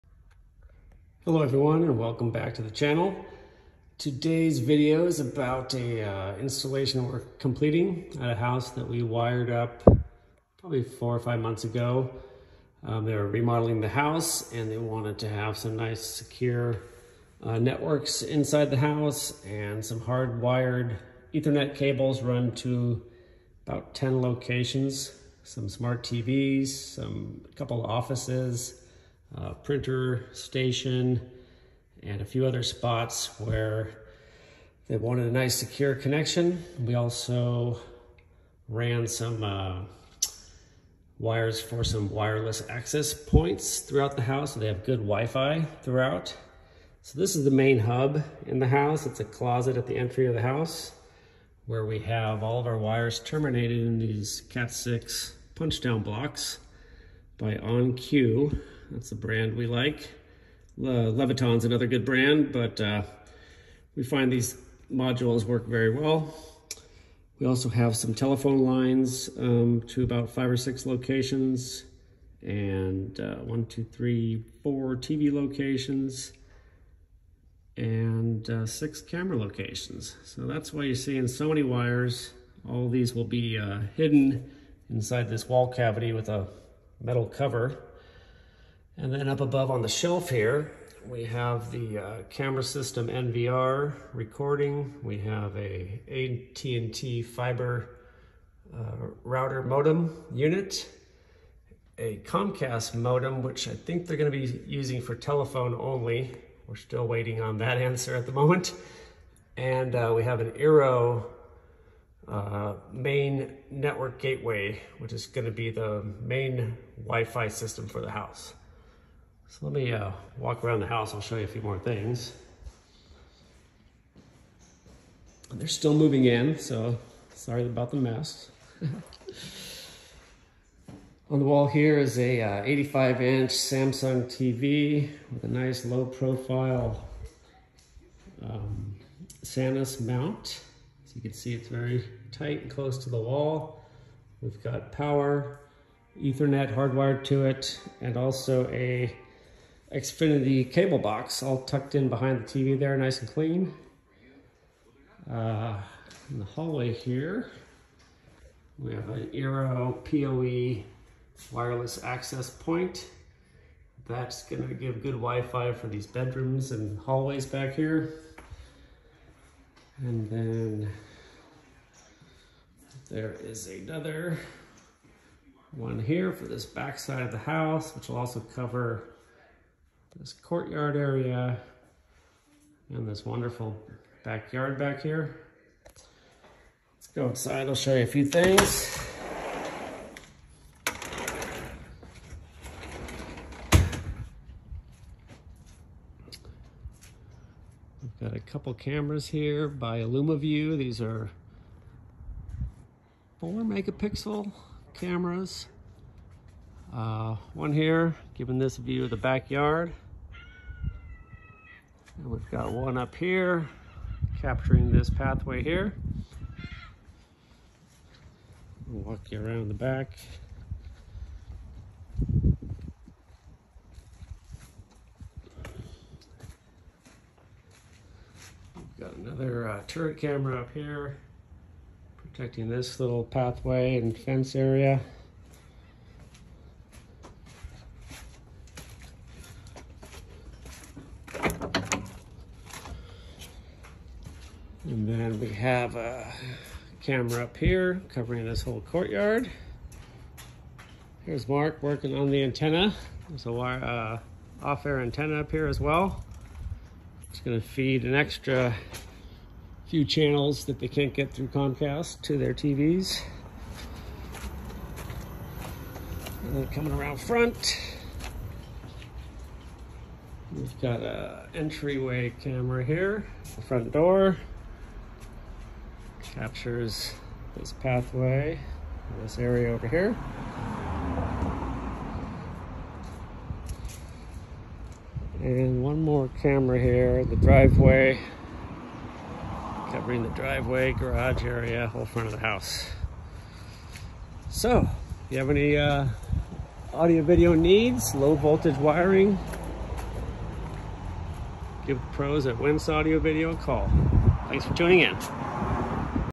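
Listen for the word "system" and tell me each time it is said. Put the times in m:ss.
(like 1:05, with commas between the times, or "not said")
1:32, 1:57.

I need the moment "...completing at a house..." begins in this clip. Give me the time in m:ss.
0:07.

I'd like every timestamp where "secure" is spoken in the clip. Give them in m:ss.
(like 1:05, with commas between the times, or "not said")
0:16, 0:35.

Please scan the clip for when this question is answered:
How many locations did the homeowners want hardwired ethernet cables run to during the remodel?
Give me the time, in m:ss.
0:23.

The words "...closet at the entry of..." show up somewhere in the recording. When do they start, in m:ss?
0:49.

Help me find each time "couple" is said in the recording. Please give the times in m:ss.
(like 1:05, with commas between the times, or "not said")
0:27, 3:18.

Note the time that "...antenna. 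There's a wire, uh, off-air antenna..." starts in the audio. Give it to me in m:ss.
4:12.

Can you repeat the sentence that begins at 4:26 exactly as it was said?
And then coming around front, we've got a entryway camera here, the front door captures this pathway, this area over here.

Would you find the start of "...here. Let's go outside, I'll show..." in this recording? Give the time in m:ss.
3:05.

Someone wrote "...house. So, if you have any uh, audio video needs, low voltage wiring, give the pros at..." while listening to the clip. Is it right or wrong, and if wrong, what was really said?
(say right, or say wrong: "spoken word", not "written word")
right.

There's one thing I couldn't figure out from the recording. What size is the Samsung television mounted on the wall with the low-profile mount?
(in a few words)
85 inch.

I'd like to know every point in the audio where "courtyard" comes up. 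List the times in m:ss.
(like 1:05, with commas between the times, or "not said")
3:00, 4:08.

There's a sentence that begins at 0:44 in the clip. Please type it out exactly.
So they have good Wi-Fi throughout.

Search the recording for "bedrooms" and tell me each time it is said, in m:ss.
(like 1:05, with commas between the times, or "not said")
2:46.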